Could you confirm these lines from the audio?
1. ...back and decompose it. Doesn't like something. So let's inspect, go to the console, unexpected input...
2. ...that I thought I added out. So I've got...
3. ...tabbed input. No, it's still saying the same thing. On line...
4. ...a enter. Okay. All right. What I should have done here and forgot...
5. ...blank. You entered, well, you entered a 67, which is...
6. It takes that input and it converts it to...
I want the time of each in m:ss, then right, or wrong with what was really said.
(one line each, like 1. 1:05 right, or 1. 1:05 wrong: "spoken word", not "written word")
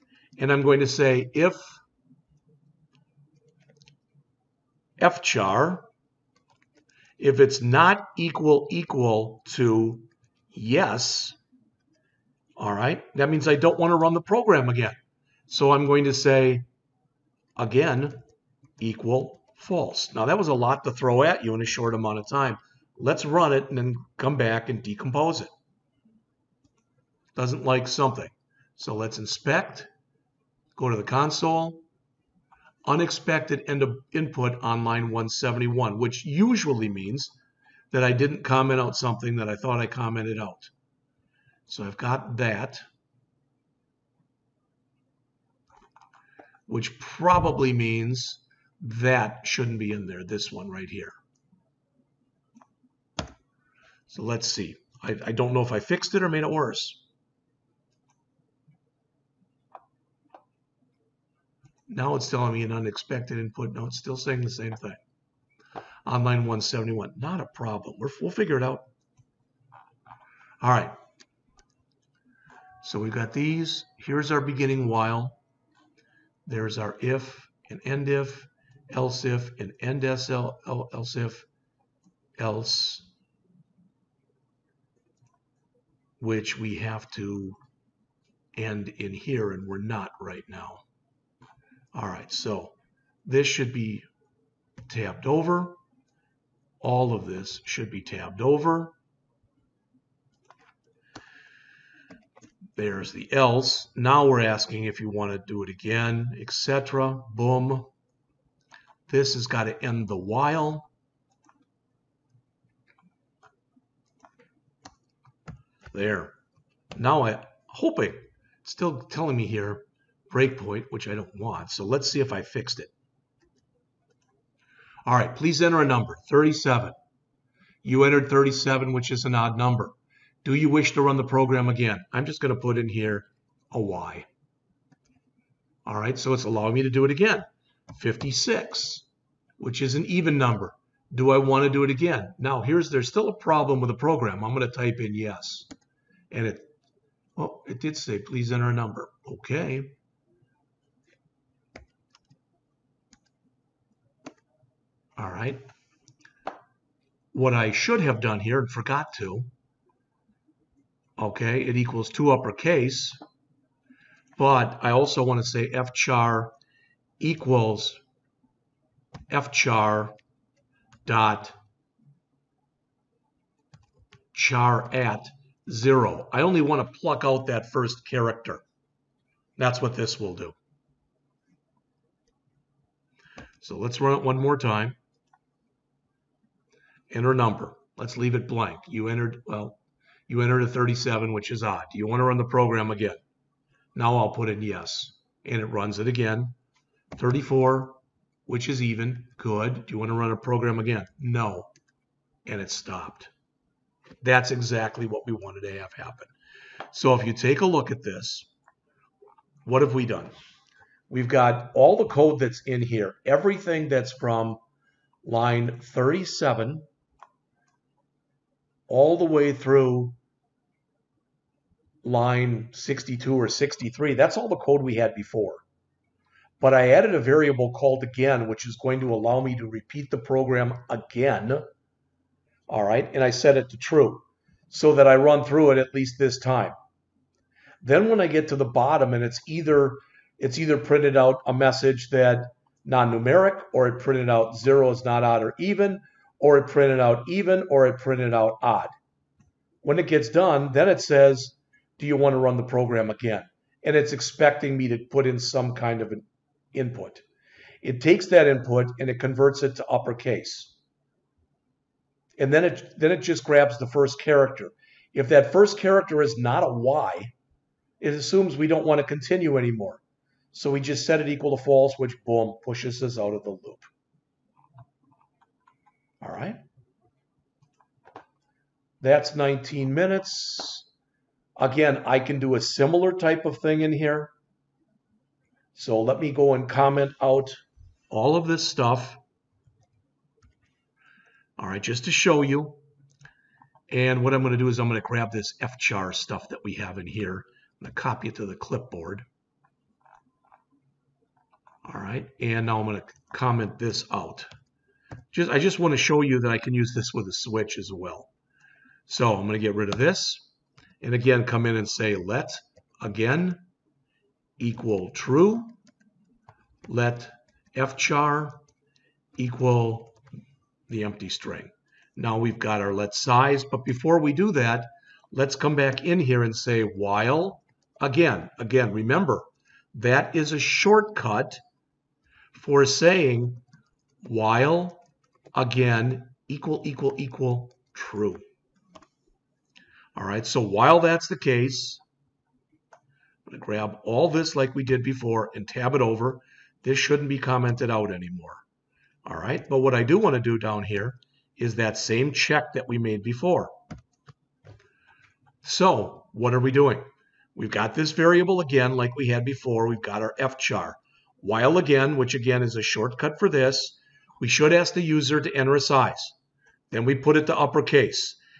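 1. 0:24 right
2. 0:39 wrong: "commented", not "added"
3. 1:02 wrong: "unexpected", not "tabbed"
4. 2:28 wrong: "number", not "enter"
5. 3:08 wrong: "37", not "67"
6. 4:17 right.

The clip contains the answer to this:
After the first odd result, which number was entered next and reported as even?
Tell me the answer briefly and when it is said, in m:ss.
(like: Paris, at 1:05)
56, at 2:17.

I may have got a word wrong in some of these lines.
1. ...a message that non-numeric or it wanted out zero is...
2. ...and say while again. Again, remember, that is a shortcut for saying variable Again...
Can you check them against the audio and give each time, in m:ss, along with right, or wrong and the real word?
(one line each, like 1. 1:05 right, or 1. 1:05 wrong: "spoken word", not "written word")
1. 4:01 wrong: "printed", not "wanted"
2. 5:26 wrong: "while", not "variable".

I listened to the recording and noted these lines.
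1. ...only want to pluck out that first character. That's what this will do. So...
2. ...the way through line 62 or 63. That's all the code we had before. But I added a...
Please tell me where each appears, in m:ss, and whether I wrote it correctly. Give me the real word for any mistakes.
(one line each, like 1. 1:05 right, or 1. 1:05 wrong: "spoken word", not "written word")
1. 2:56 right
2. 3:39 right.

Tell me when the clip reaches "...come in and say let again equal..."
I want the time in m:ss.
5:11.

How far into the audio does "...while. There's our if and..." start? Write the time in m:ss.
1:14.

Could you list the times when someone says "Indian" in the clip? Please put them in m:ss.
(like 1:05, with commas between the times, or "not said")
not said.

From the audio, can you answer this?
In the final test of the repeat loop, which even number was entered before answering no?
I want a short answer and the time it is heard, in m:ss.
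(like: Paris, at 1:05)
34, at 3:17.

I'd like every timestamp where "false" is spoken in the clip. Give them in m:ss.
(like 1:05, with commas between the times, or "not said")
0:19, 4:31.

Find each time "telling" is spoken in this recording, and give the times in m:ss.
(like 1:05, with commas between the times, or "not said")
1:02, 1:59.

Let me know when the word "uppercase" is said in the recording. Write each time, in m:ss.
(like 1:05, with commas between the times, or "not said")
2:42, 4:19, 6:07.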